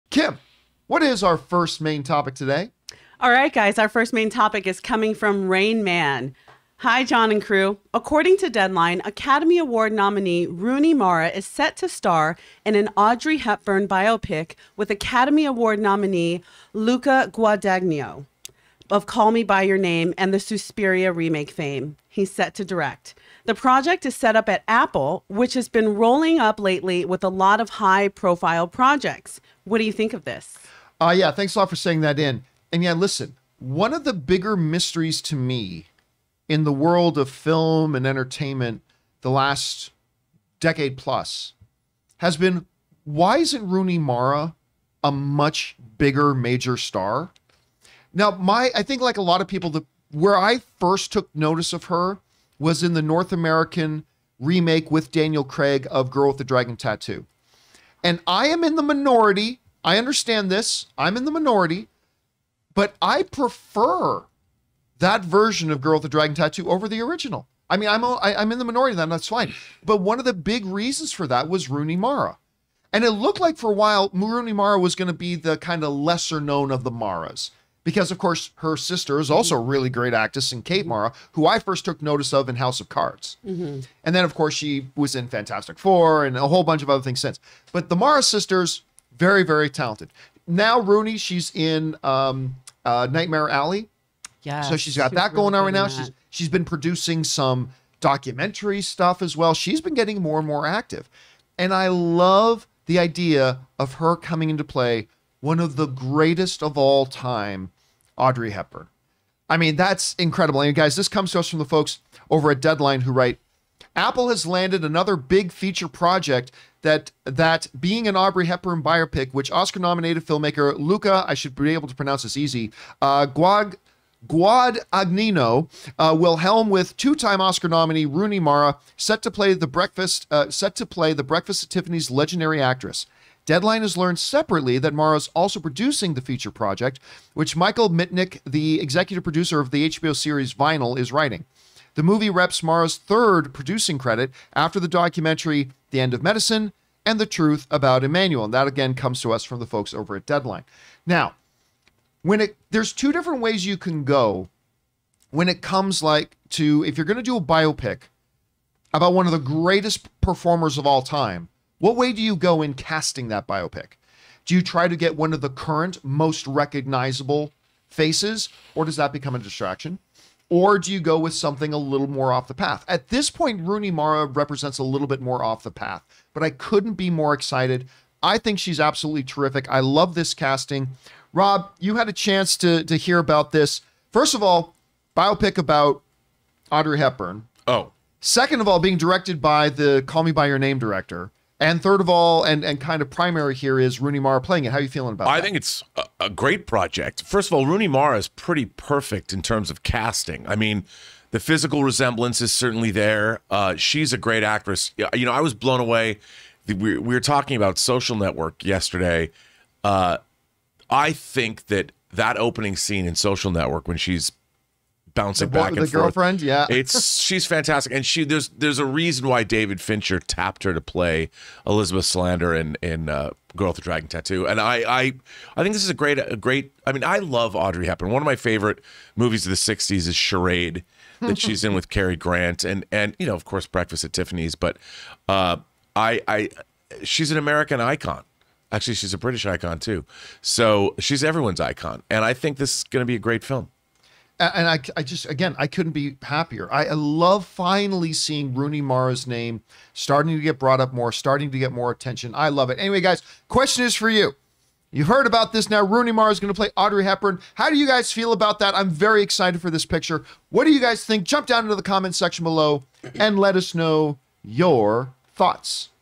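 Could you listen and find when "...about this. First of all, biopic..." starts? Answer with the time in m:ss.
3:03.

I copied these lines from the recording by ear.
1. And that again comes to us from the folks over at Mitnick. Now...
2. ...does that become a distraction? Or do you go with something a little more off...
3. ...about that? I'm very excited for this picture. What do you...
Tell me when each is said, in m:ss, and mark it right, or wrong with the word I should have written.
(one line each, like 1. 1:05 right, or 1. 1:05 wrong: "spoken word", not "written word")
1. 2:28 wrong: "Deadline", not "Mitnick"
2. 2:48 right
3. 4:18 right.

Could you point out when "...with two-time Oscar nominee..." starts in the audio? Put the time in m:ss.
2:06.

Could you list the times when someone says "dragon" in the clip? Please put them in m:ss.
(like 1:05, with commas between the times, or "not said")
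0:56, 1:06, 3:43.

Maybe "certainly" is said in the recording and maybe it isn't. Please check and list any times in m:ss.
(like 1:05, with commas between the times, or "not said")
3:22.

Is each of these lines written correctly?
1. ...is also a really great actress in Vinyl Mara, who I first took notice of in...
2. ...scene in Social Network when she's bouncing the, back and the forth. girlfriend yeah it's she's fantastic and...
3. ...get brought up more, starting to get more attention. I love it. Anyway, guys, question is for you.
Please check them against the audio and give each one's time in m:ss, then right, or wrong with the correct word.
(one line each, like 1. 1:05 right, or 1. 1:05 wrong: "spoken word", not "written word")
1. 1:19 wrong: "Kate", not "Vinyl"
2. 3:32 right
3. 4:10 right.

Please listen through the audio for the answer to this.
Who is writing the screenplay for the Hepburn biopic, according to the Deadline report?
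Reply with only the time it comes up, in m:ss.
2:17.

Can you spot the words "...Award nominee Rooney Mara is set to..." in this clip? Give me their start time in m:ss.
0:09.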